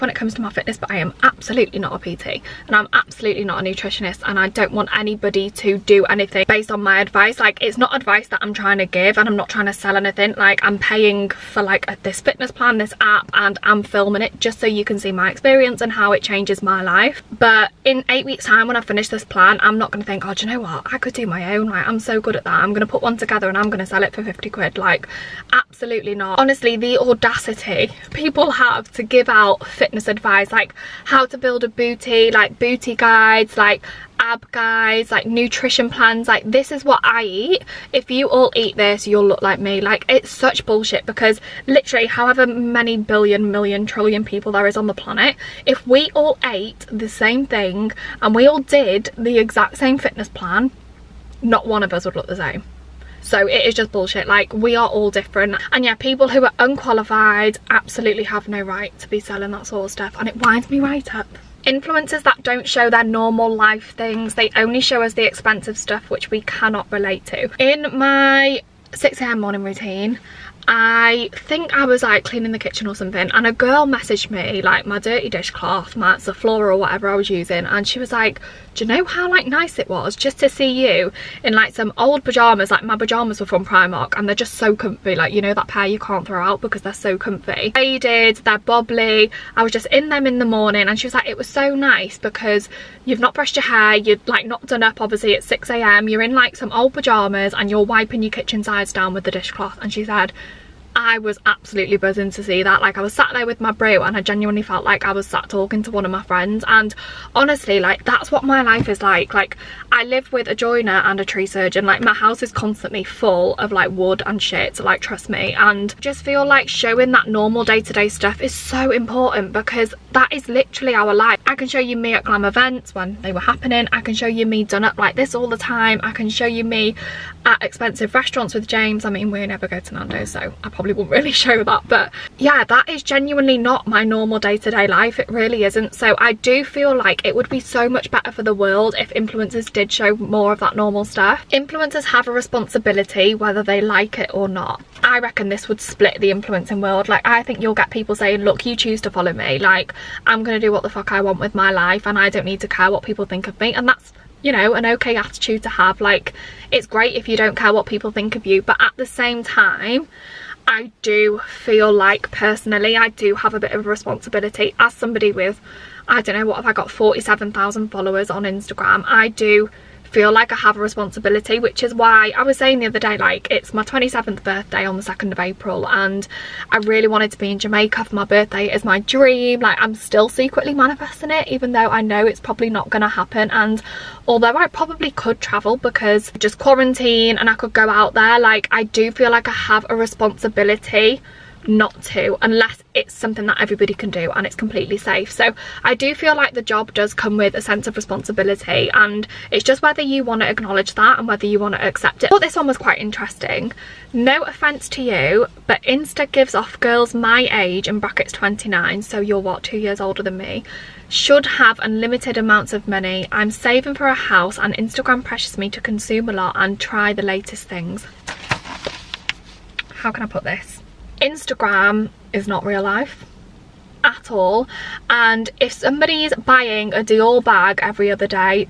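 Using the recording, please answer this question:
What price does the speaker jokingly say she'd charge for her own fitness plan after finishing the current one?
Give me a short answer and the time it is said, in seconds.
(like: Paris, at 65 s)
50 quid, at 24 s.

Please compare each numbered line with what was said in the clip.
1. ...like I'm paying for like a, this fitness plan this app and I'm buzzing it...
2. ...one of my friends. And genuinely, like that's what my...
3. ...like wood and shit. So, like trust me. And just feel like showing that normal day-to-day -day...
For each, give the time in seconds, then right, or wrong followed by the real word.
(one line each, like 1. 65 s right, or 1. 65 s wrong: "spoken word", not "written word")
1. 10 s wrong: "filming", not "buzzing"
2. 105 s wrong: "honestly", not "genuinely"
3. 113 s right.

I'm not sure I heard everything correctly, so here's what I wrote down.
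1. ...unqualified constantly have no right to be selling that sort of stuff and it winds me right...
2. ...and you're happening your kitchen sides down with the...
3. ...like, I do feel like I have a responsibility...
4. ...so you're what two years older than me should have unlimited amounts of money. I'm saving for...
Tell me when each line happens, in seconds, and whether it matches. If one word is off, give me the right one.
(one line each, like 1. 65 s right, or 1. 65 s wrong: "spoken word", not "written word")
1. 56 s wrong: "absolutely", not "constantly"
2. 97 s wrong: "wiping", not "happening"
3. 188 s right
4. 209 s right.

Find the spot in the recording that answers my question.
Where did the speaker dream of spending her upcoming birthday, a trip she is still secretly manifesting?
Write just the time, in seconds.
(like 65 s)
177 s.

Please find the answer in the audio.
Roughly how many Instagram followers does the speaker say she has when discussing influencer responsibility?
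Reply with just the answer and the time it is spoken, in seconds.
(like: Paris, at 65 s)
47,000, at 166 s.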